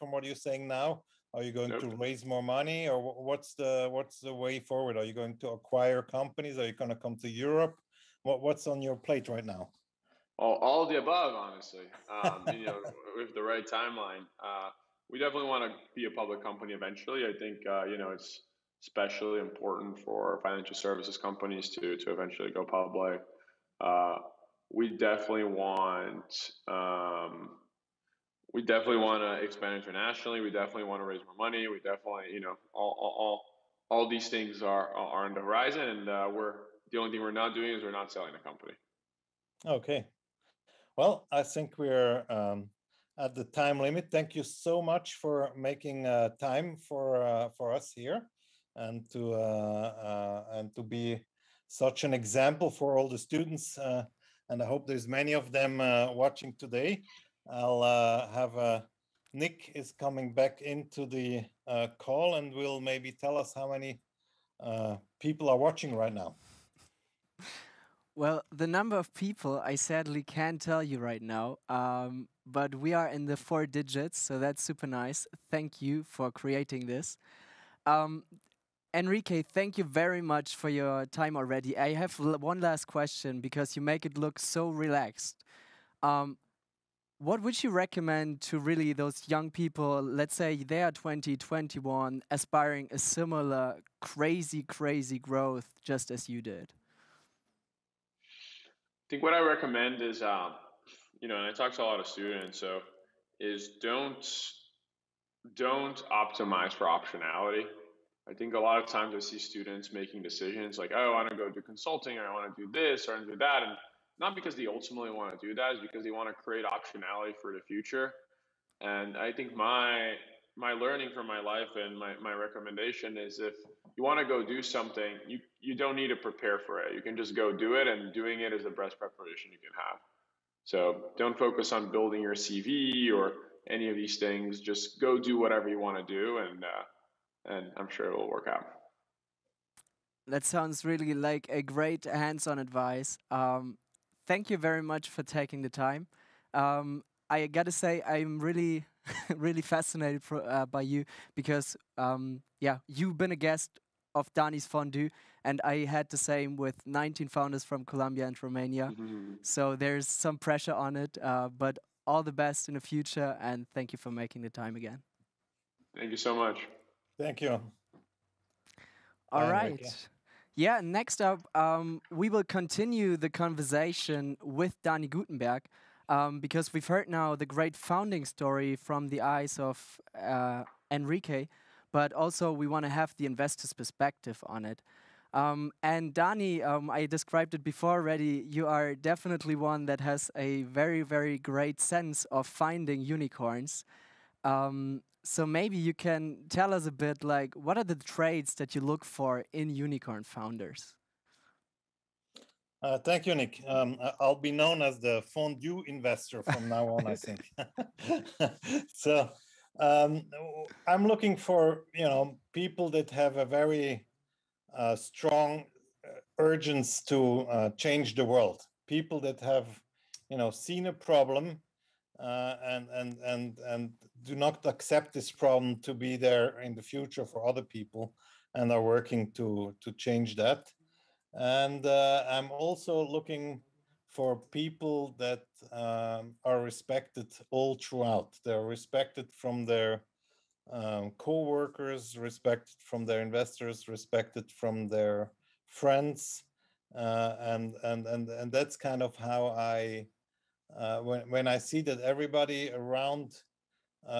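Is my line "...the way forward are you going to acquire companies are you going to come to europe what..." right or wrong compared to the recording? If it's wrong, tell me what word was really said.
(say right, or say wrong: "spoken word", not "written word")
right.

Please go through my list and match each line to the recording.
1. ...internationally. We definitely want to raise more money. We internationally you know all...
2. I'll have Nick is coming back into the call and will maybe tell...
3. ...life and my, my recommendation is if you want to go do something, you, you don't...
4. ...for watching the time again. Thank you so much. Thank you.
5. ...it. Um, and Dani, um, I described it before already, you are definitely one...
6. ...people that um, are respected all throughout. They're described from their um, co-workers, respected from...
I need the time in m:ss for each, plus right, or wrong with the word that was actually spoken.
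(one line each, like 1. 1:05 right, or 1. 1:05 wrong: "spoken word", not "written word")
1. 0:29 wrong: "definitely", not "internationally"
2. 0:57 right
3. 2:01 right
4. 2:44 wrong: "making", not "watching"
5. 3:04 right
6. 3:54 wrong: "respected", not "described".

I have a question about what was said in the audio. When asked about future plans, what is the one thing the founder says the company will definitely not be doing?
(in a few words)
Selling the company.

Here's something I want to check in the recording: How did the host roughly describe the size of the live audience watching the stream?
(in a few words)
Four digits.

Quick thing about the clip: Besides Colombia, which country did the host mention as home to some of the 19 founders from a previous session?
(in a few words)
Romania.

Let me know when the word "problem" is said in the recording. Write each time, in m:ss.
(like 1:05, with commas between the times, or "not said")
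3:40, 3:45.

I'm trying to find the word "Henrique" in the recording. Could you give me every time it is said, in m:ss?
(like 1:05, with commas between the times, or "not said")
1:18, 3:00.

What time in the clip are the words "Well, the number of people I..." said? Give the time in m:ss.
1:08.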